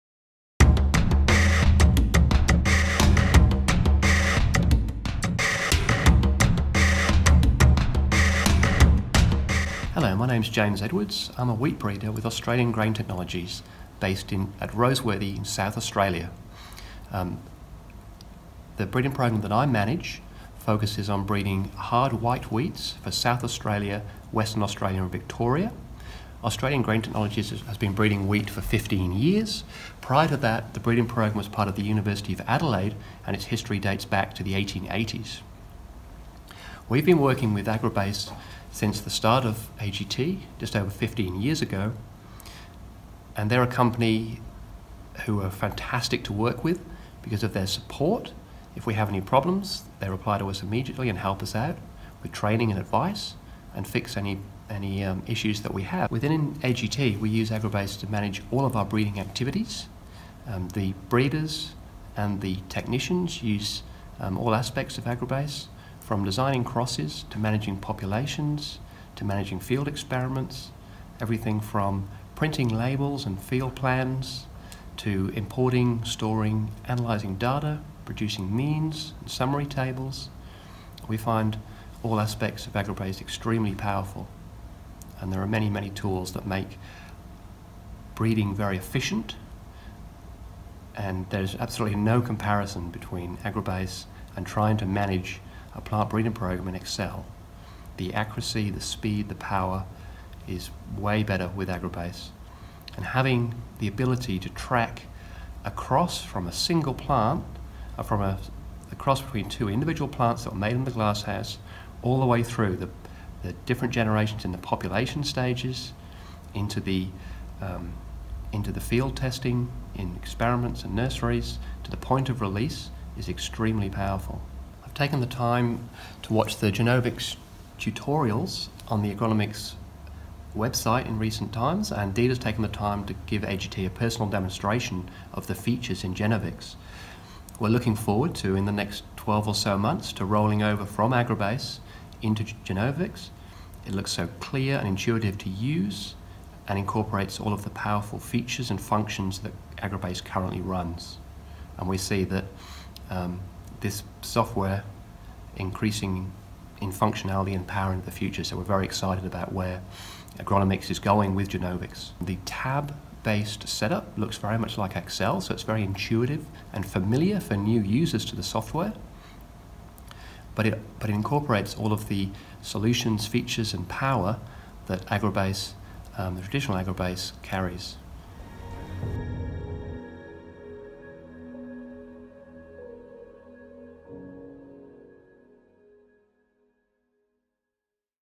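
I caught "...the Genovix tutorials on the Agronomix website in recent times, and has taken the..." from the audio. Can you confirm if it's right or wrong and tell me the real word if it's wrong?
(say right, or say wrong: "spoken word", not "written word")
right.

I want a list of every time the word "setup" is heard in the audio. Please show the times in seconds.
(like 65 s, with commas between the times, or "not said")
163 s.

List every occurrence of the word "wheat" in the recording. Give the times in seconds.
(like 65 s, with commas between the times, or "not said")
11 s, 22 s, 28 s.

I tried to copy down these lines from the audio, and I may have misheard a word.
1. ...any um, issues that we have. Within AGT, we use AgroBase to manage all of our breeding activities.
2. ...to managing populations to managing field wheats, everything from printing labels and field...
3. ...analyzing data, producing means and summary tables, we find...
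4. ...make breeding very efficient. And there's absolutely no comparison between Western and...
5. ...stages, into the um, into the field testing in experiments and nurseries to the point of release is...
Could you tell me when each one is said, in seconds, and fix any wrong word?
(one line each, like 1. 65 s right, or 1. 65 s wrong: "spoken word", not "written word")
1. 54 s right
2. 67 s wrong: "experiments", not "wheats"
3. 76 s right
4. 86 s wrong: "AgroBase", not "Western"
5. 115 s right.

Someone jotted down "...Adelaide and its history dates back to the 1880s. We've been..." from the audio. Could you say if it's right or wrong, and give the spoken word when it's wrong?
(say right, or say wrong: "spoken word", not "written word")
right.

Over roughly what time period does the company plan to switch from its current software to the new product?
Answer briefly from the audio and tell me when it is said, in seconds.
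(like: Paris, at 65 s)
12 months, at 139 s.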